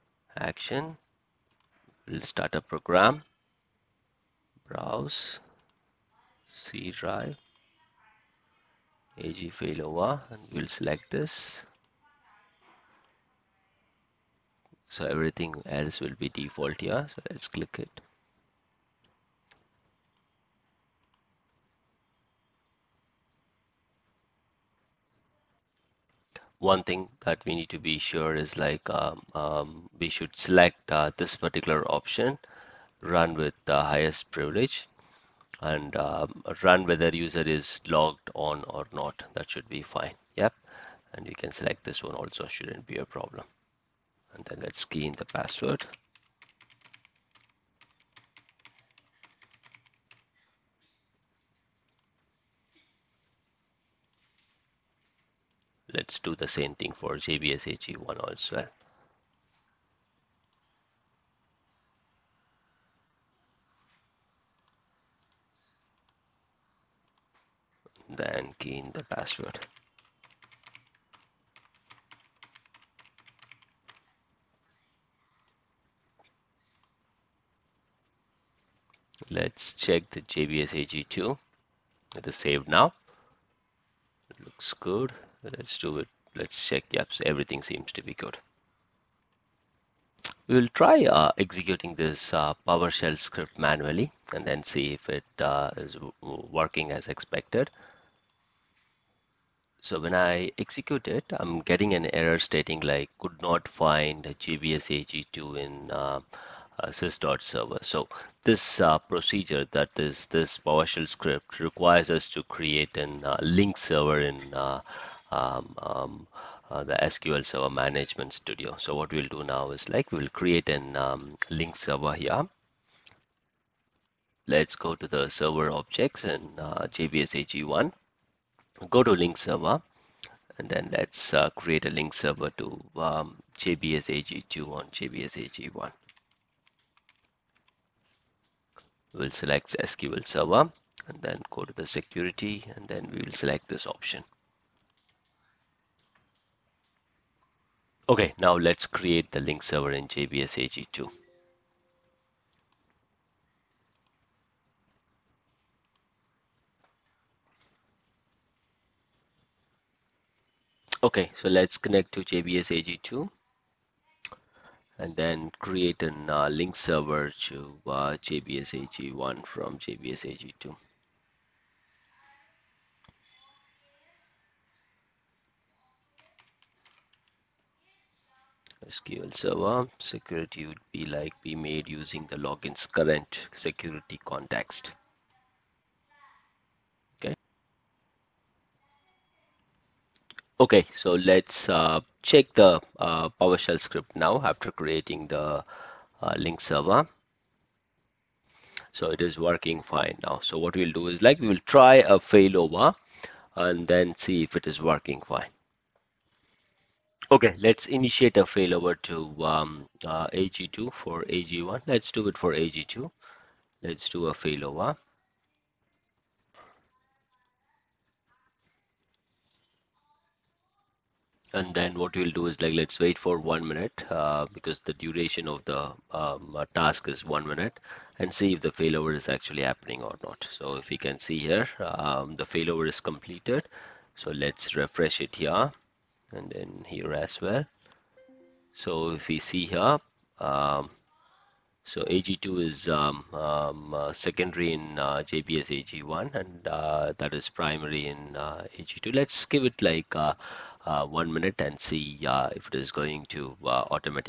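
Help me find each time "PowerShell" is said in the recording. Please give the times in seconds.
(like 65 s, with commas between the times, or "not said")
92 s, 110 s, 193 s.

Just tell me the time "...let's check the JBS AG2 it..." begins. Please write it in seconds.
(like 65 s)
79 s.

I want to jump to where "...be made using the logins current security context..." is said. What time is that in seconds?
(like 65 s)
181 s.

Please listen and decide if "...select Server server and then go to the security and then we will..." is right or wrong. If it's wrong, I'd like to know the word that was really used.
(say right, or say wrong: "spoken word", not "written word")
wrong: "SQL", not "Server".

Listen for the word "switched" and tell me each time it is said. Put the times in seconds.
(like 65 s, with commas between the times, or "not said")
not said.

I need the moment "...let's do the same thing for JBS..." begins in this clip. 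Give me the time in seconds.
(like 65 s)
55 s.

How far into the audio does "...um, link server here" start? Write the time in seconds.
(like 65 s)
120 s.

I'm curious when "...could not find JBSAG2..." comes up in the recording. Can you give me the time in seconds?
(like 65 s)
103 s.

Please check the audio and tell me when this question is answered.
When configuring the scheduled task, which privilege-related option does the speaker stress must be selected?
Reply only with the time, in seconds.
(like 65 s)
33 s.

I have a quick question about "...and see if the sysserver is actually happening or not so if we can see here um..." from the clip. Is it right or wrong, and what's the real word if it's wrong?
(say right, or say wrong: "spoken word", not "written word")
wrong: "failover", not "sysserver".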